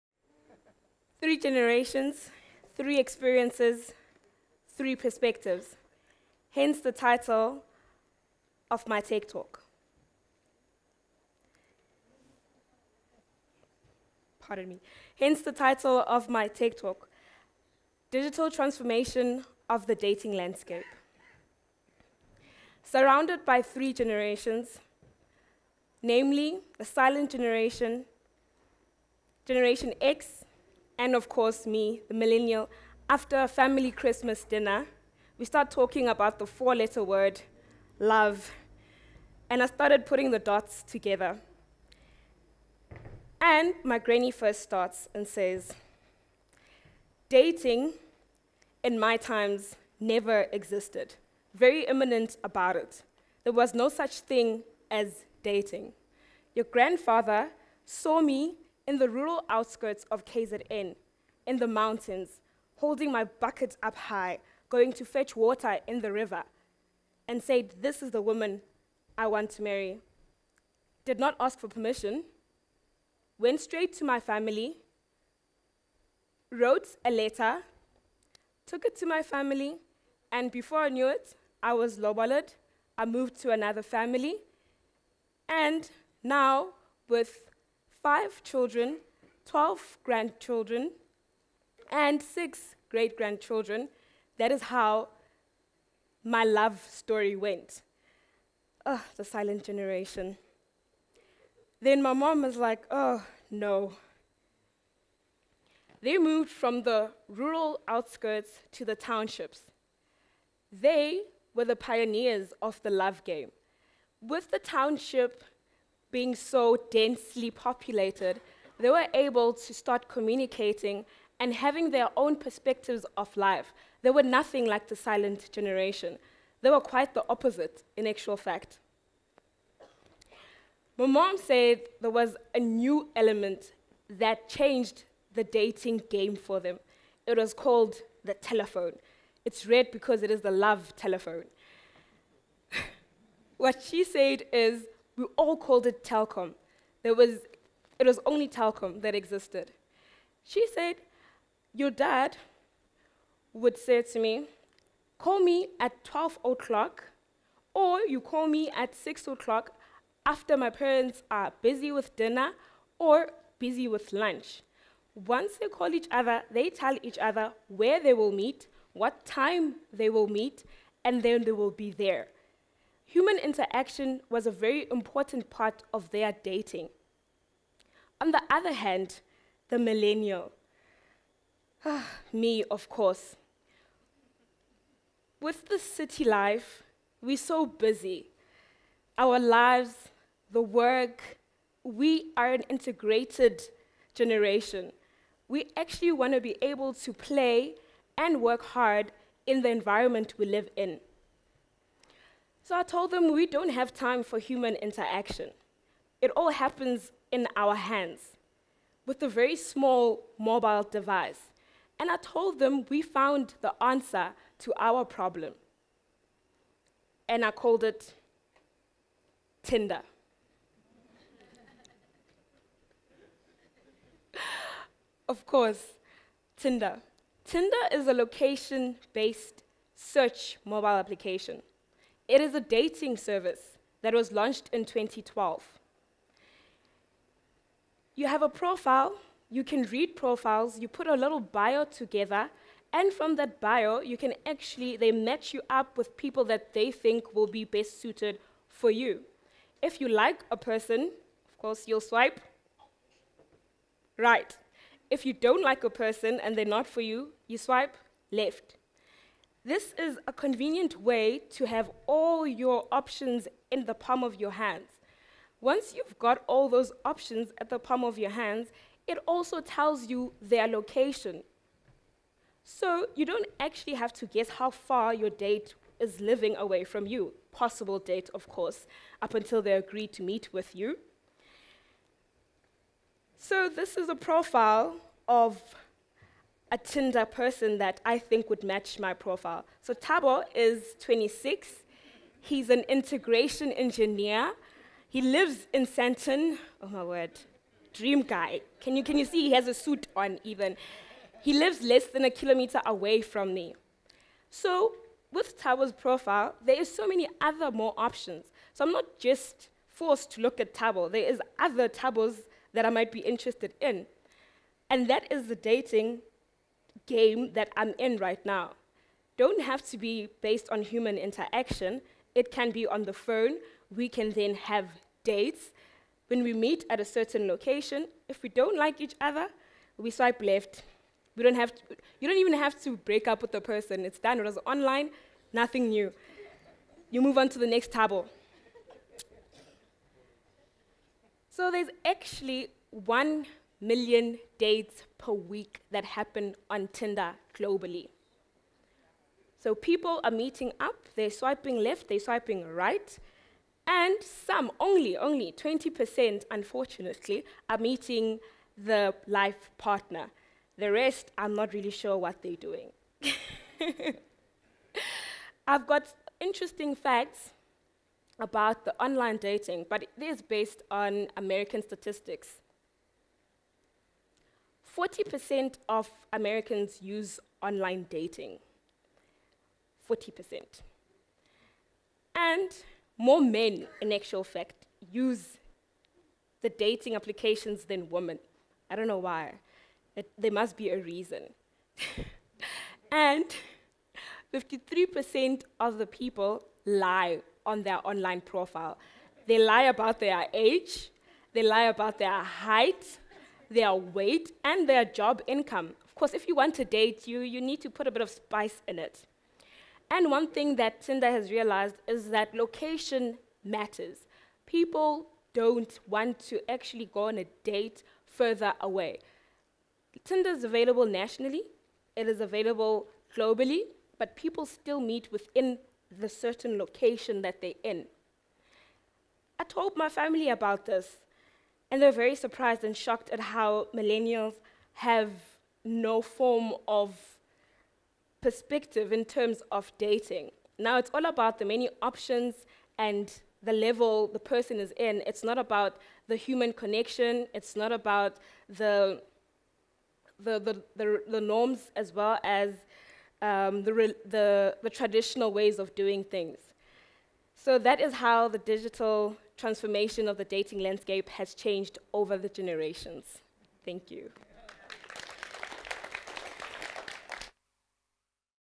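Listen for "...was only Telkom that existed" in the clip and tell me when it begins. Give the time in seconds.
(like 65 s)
148 s.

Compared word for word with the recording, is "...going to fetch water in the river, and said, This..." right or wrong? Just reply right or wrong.
right.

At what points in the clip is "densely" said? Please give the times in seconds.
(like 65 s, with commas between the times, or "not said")
116 s.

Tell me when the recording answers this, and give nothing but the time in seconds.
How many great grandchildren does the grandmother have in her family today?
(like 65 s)
92 s.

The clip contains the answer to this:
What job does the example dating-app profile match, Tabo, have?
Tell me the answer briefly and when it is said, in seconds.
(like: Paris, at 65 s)
Integration engineer, at 292 s.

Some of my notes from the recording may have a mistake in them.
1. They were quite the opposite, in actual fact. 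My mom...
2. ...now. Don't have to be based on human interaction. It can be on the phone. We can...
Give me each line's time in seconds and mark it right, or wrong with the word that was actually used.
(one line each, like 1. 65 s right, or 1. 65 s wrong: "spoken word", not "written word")
1. 126 s right
2. 318 s right.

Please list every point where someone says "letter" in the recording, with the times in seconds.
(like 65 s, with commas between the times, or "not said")
36 s, 77 s.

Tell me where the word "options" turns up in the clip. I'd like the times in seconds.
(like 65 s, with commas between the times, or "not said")
262 s, 267 s, 307 s, 442 s.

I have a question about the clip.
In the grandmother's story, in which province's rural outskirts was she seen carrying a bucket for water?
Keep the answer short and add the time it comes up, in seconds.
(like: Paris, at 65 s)
KZN, at 60 s.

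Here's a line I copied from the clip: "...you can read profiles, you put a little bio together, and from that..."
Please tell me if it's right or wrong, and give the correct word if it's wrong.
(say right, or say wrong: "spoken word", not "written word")
right.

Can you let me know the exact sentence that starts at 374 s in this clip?
40% of Americans use online dating.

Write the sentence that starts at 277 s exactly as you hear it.
Possible date, of course, up until they agree to meet with you.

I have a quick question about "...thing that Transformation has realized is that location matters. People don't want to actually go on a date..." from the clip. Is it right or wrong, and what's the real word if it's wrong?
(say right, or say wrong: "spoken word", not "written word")
wrong: "Tinder", not "Transformation".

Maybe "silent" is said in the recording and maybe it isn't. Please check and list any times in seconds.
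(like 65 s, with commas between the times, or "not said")
26 s, 99 s, 124 s.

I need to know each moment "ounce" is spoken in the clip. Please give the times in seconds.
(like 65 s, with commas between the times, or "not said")
not said.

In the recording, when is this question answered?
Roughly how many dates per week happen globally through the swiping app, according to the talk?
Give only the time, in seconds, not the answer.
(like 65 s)
342 s.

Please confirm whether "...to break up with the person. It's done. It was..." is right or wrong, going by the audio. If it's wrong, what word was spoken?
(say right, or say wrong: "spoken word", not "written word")
right.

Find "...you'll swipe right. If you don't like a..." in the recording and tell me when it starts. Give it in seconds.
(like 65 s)
251 s.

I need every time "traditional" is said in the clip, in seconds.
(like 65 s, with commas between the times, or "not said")
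454 s.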